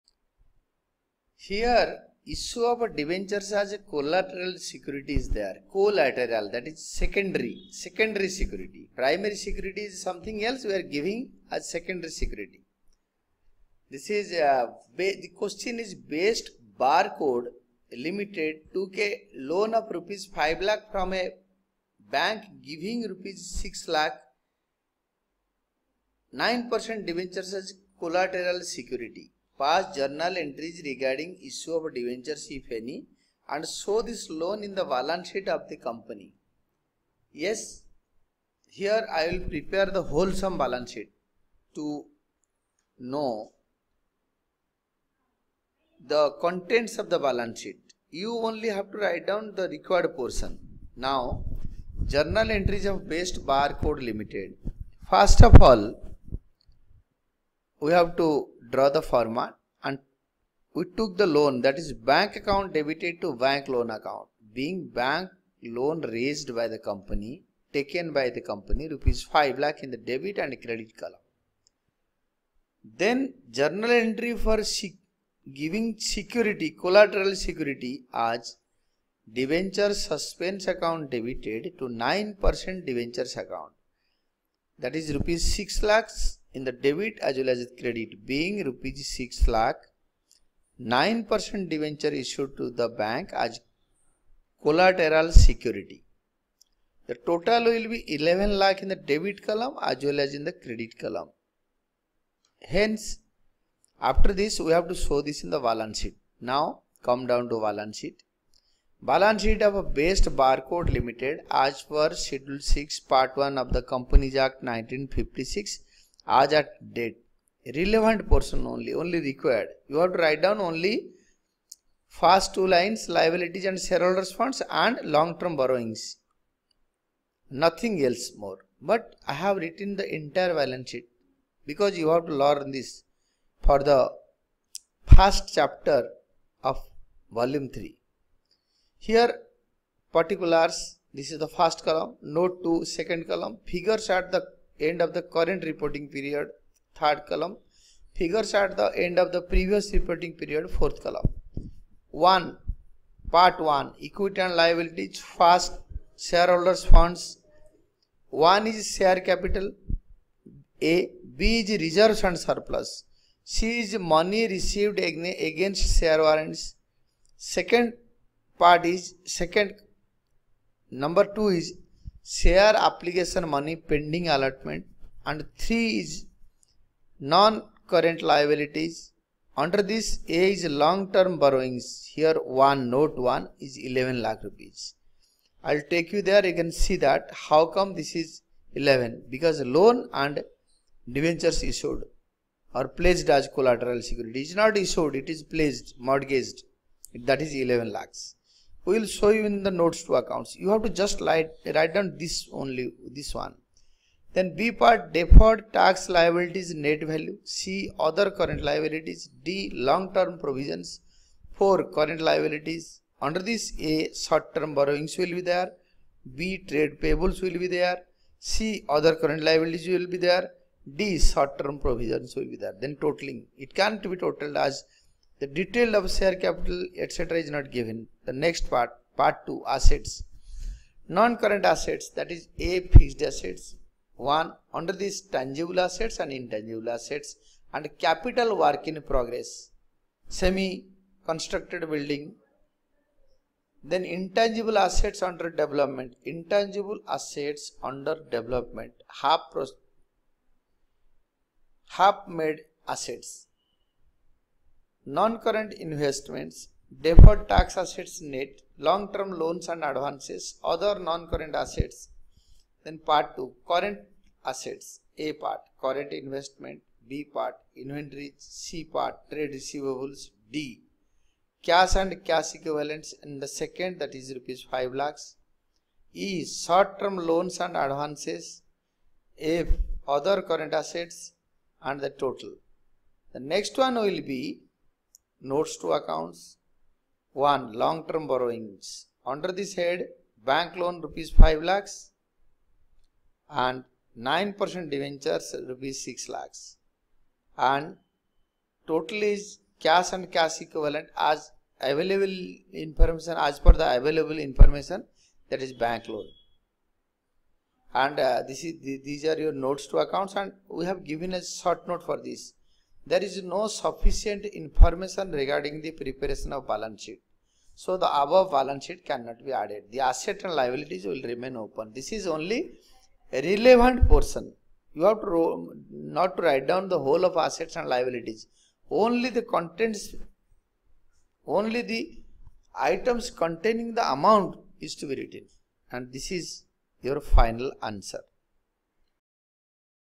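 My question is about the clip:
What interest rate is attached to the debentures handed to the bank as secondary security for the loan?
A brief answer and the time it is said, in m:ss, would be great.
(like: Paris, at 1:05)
9%, at 0:26.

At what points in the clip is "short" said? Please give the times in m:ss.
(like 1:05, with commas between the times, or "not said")
3:34, 3:41, 4:36, 5:11.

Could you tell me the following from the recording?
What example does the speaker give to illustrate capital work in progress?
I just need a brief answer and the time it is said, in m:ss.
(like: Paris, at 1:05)
Semi constructed building, at 4:00.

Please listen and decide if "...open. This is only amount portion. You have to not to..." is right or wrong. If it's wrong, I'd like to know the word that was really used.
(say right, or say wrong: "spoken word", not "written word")
wrong: "relevant", not "amount".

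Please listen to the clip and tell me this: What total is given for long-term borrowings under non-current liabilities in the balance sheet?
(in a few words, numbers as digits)
11 lakh rupees.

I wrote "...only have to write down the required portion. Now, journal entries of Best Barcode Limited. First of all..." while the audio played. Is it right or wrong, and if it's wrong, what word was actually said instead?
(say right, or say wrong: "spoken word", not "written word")
right.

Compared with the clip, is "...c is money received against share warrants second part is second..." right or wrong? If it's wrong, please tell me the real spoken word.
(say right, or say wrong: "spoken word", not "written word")
right.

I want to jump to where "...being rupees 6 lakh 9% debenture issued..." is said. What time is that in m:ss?
1:28.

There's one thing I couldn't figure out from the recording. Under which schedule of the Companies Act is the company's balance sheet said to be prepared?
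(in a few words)
Schedule 6 Part 1.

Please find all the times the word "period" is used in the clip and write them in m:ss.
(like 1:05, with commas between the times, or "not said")
2:26, 2:30.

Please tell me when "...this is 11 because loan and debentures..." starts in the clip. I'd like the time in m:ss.
3:08.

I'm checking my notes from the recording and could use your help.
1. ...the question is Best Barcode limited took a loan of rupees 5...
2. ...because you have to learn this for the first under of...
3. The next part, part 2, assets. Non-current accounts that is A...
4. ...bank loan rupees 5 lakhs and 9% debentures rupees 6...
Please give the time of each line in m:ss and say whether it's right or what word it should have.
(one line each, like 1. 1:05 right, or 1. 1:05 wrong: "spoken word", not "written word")
1. 0:14 right
2. 2:11 wrong: "chapter", not "under"
3. 3:48 wrong: "assets", not "accounts"
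4. 4:50 right.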